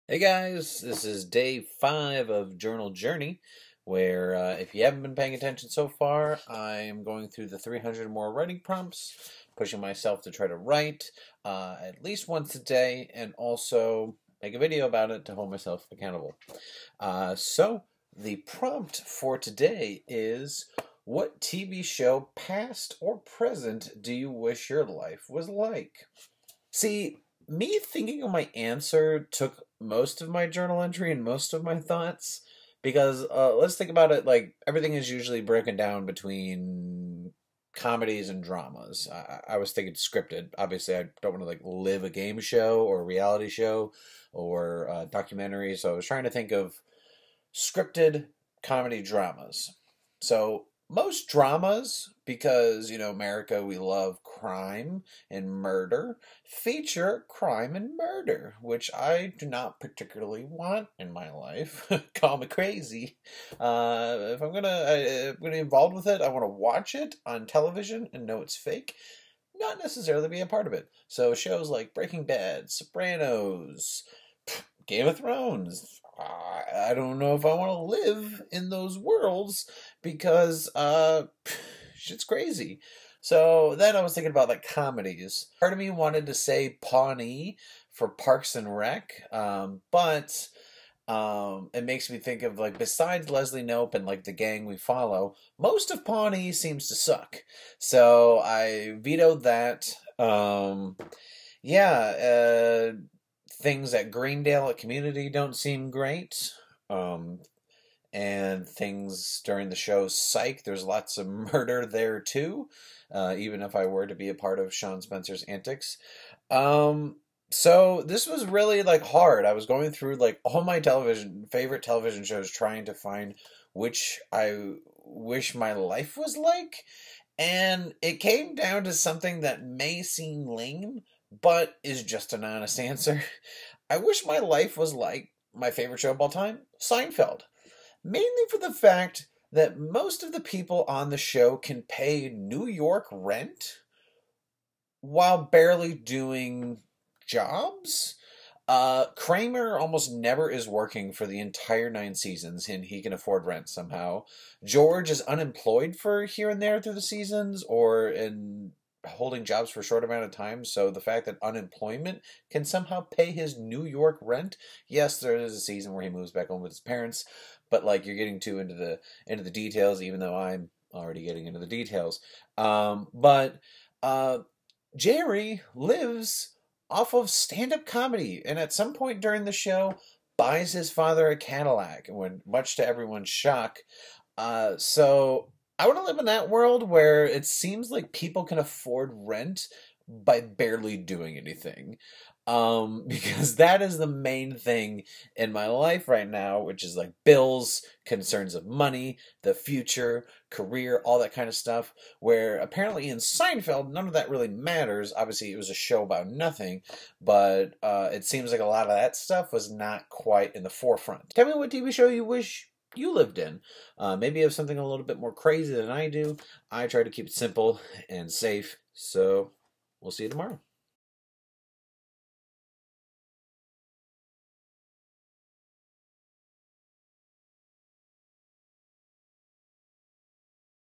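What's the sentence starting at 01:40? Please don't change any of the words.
Um, yeah, uh, things at Greendale at community don't seem great.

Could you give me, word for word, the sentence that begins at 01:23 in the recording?
So then I was thinking about like comedies.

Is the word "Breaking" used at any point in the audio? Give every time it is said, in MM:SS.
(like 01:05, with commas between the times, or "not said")
01:11.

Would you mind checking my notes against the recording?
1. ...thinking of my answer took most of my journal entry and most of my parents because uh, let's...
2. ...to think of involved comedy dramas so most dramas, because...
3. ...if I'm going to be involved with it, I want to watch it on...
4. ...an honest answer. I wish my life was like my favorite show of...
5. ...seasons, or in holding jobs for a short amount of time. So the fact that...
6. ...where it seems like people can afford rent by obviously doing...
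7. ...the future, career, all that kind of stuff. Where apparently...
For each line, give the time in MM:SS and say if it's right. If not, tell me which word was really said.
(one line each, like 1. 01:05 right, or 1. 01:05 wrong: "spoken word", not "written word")
1. 00:27 wrong: "thoughts", not "parents"
2. 00:46 wrong: "scripted", not "involved"
3. 01:04 right
4. 02:12 right
5. 02:37 right
6. 03:06 wrong: "barely", not "obviously"
7. 03:19 right.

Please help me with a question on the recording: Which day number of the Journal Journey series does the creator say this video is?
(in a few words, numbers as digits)
5.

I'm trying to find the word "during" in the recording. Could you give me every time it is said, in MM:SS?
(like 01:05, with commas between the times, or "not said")
01:49, 02:59.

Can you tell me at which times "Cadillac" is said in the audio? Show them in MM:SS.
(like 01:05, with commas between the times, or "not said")
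03:01.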